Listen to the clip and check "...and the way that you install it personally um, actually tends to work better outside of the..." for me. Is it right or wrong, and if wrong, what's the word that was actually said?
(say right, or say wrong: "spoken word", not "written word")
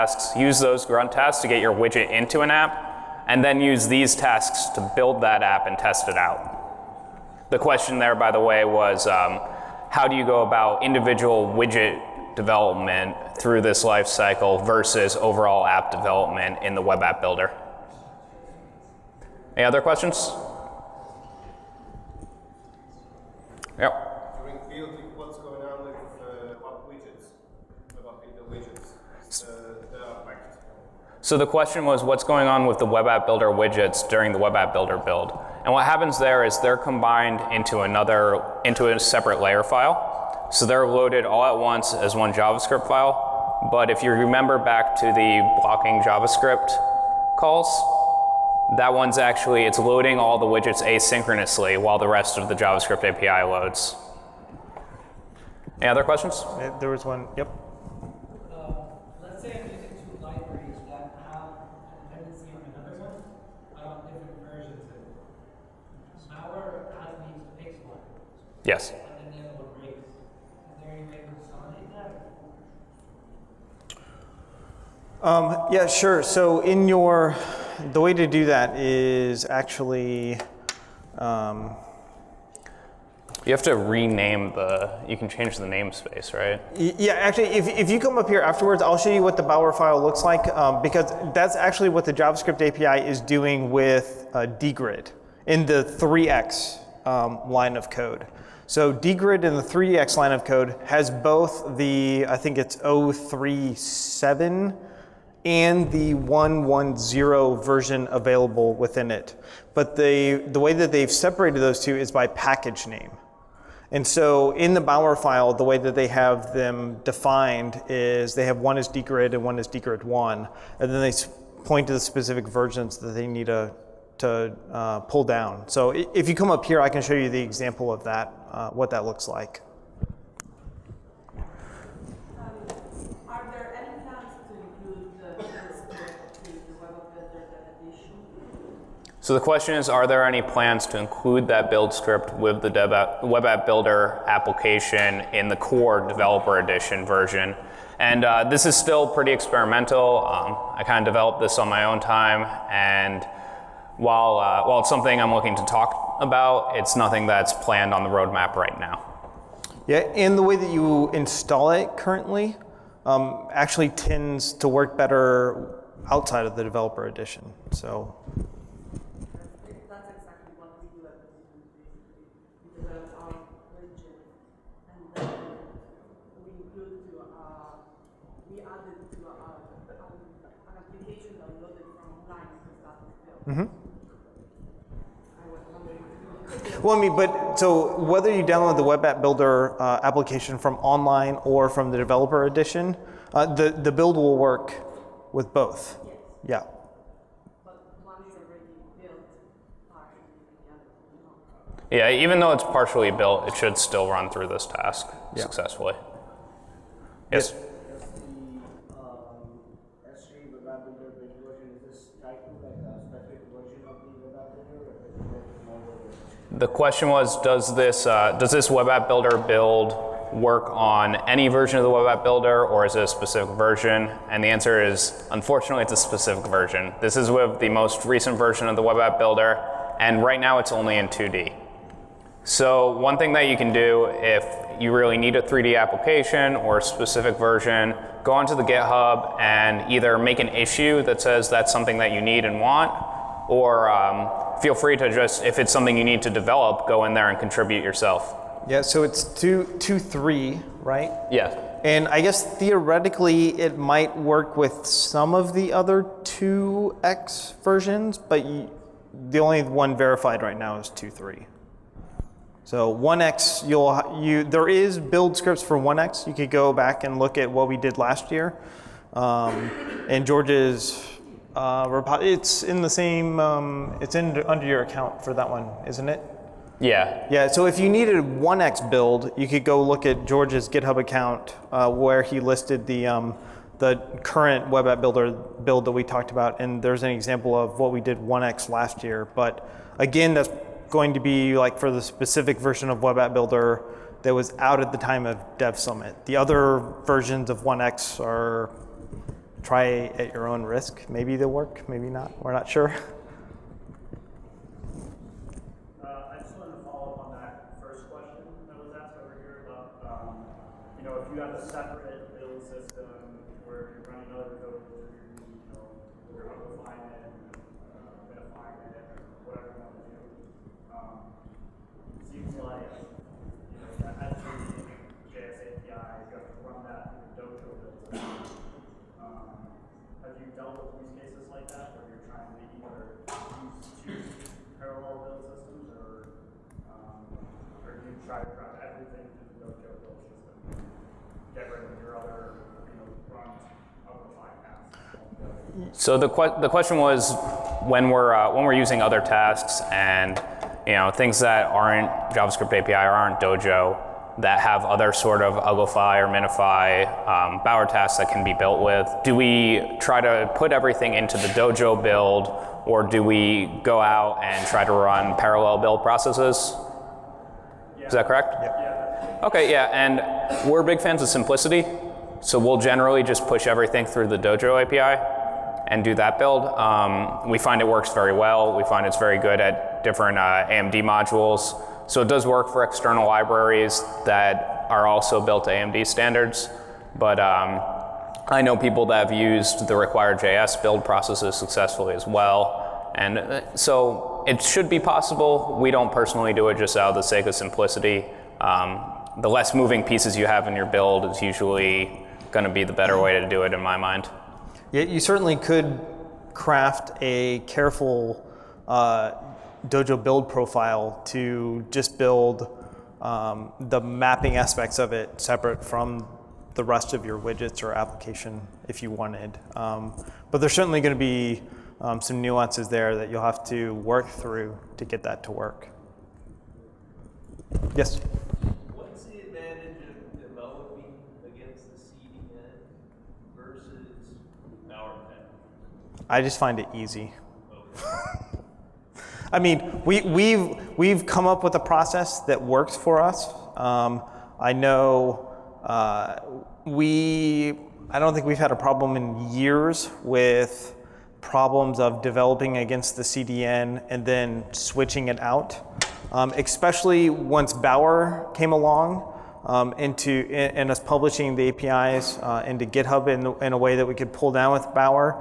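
wrong: "currently", not "personally".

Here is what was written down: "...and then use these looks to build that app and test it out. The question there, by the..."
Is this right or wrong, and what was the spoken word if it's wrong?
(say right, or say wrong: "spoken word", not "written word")
wrong: "tasks", not "looks".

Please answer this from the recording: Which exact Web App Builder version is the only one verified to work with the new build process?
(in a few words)
2.3.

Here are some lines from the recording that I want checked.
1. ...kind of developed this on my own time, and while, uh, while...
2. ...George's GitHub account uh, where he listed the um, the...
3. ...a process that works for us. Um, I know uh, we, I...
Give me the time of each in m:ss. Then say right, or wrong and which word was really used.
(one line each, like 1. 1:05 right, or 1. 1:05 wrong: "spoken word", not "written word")
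1. 2:30 right
2. 4:40 right
3. 7:21 right.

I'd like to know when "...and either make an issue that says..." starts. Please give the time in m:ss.
3:59.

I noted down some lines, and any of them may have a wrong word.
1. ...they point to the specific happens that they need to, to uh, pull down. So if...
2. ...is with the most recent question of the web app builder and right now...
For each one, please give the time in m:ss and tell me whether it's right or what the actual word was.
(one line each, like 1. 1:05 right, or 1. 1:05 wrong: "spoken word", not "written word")
1. 2:01 wrong: "versions", not "happens"
2. 3:47 wrong: "version", not "question".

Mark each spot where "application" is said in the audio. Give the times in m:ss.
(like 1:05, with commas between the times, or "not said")
2:24, 3:10, 3:55, 6:57.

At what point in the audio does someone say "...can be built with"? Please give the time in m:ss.
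5:58.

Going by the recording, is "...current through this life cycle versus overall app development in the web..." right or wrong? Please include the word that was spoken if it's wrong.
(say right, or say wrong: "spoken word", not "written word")
wrong: "development", not "current".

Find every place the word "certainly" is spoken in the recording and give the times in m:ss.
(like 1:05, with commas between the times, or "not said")
6:45, 7:00.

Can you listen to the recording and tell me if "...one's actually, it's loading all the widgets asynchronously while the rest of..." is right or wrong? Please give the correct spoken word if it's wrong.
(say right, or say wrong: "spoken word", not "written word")
right.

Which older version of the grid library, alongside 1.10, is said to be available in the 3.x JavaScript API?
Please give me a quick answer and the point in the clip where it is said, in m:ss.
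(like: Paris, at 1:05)
0.3.7, at 1:42.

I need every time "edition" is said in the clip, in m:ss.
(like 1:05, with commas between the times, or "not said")
2:26, 2:47, 3:12.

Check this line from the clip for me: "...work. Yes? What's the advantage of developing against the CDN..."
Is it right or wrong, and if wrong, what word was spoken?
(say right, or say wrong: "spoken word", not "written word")
right.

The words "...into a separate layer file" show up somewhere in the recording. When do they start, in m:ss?
0:38.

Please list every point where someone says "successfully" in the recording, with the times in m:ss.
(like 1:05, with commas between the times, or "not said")
3:25, 6:31.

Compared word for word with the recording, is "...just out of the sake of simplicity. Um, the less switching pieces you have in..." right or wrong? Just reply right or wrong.
wrong.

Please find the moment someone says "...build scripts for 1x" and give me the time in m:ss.
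4:24.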